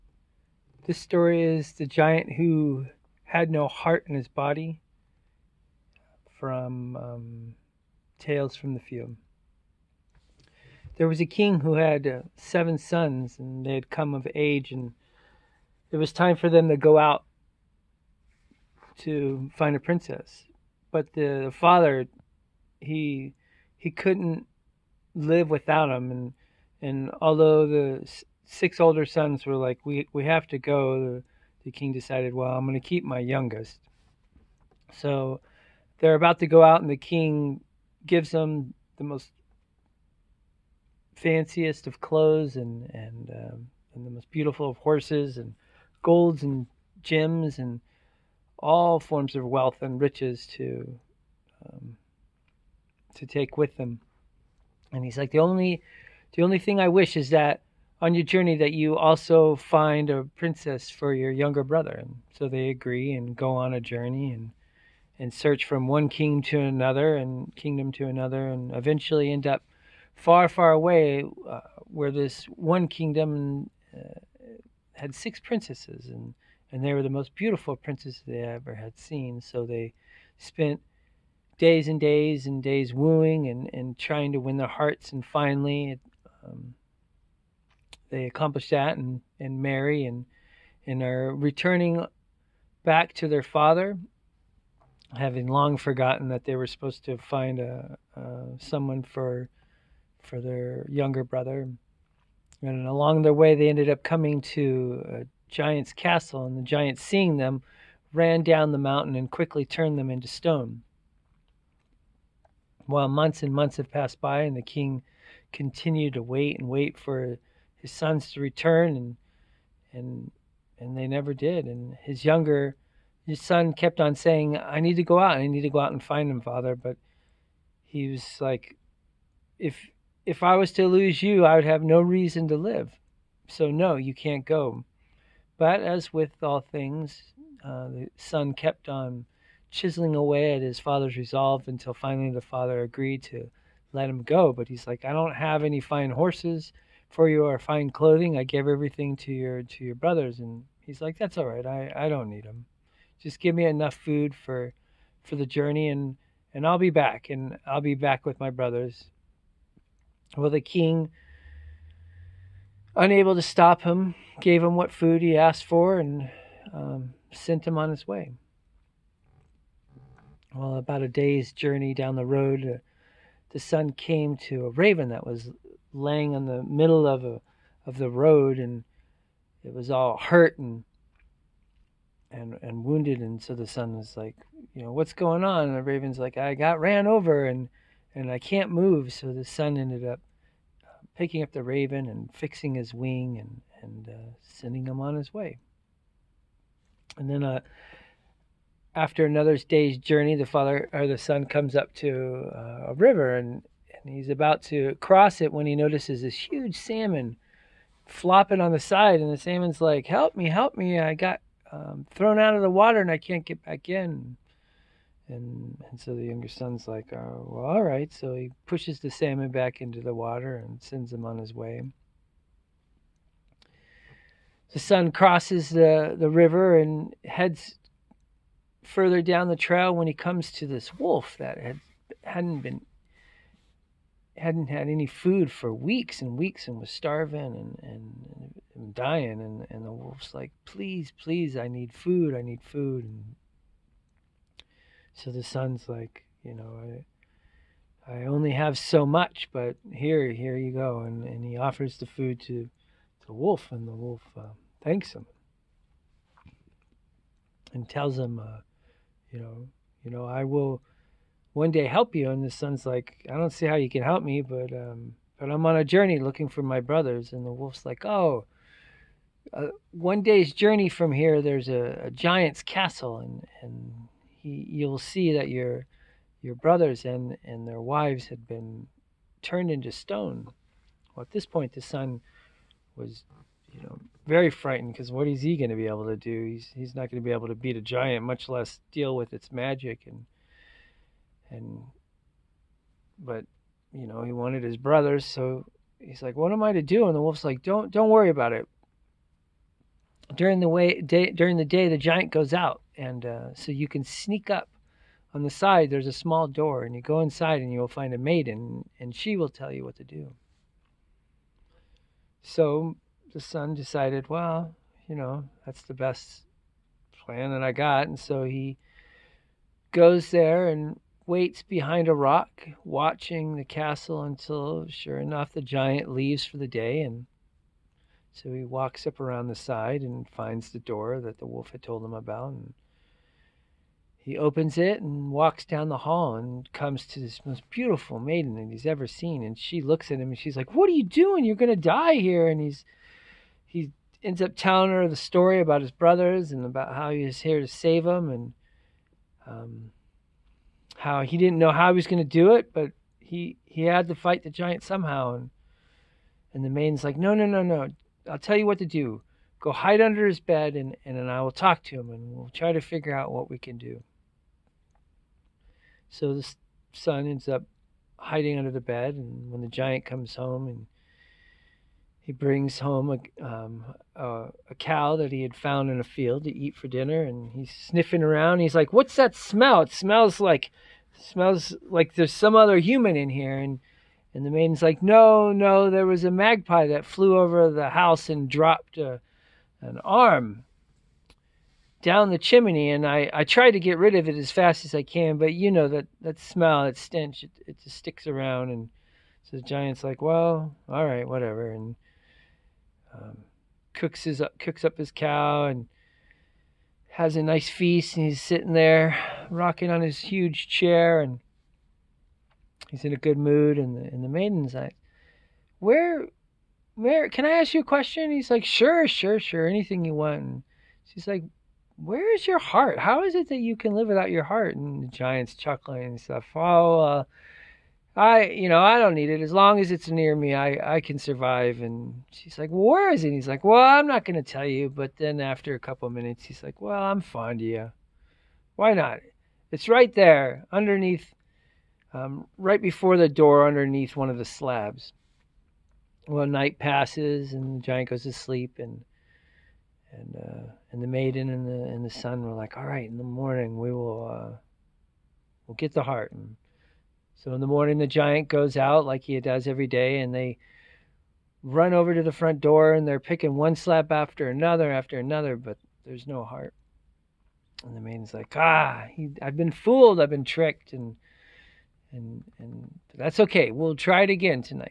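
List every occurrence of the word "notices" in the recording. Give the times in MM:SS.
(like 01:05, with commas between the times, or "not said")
03:25.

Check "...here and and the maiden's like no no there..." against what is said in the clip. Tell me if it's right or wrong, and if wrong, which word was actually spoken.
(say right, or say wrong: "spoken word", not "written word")
right.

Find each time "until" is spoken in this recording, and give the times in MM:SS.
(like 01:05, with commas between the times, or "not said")
02:21, 05:24.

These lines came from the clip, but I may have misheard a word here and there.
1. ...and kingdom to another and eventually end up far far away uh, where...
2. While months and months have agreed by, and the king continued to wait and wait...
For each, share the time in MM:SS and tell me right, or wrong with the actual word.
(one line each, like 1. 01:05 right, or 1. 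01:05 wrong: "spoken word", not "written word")
1. 01:07 right
2. 01:52 wrong: "passed", not "agreed".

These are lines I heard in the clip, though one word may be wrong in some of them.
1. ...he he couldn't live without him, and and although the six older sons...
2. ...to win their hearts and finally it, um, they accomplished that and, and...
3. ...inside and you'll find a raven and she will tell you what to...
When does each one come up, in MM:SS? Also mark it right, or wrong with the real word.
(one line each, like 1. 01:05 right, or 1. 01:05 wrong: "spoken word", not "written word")
1. 00:22 right
2. 01:24 right
3. 05:07 wrong: "maiden", not "raven".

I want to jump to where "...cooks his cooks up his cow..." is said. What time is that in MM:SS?
06:43.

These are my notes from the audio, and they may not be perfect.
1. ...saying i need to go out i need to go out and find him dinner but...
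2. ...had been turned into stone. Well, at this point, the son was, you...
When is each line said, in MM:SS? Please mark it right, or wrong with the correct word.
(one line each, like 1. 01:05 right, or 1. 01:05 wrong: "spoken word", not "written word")
1. 02:04 wrong: "father", not "dinner"
2. 04:38 right.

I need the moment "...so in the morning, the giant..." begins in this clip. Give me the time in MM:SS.
07:37.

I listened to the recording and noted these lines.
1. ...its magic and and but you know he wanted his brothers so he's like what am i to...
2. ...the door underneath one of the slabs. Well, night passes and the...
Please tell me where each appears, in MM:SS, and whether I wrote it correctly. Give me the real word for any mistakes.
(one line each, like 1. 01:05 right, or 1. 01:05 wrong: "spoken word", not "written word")
1. 04:49 right
2. 07:23 right.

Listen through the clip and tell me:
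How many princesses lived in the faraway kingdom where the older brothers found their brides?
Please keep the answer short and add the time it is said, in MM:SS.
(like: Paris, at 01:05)
6, at 01:15.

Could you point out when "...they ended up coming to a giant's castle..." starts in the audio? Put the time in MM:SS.
01:43.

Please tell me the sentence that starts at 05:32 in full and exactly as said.
And he opens it and walks down the hall and comes to this most beautiful maiden that he's ever seen.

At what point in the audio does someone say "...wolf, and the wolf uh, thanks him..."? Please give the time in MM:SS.
04:13.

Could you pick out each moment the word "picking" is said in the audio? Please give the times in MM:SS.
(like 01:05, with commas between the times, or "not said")
03:11, 07:43.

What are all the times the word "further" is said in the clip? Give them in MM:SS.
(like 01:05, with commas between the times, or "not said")
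03:48.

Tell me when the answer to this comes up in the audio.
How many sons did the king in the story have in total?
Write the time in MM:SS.
00:12.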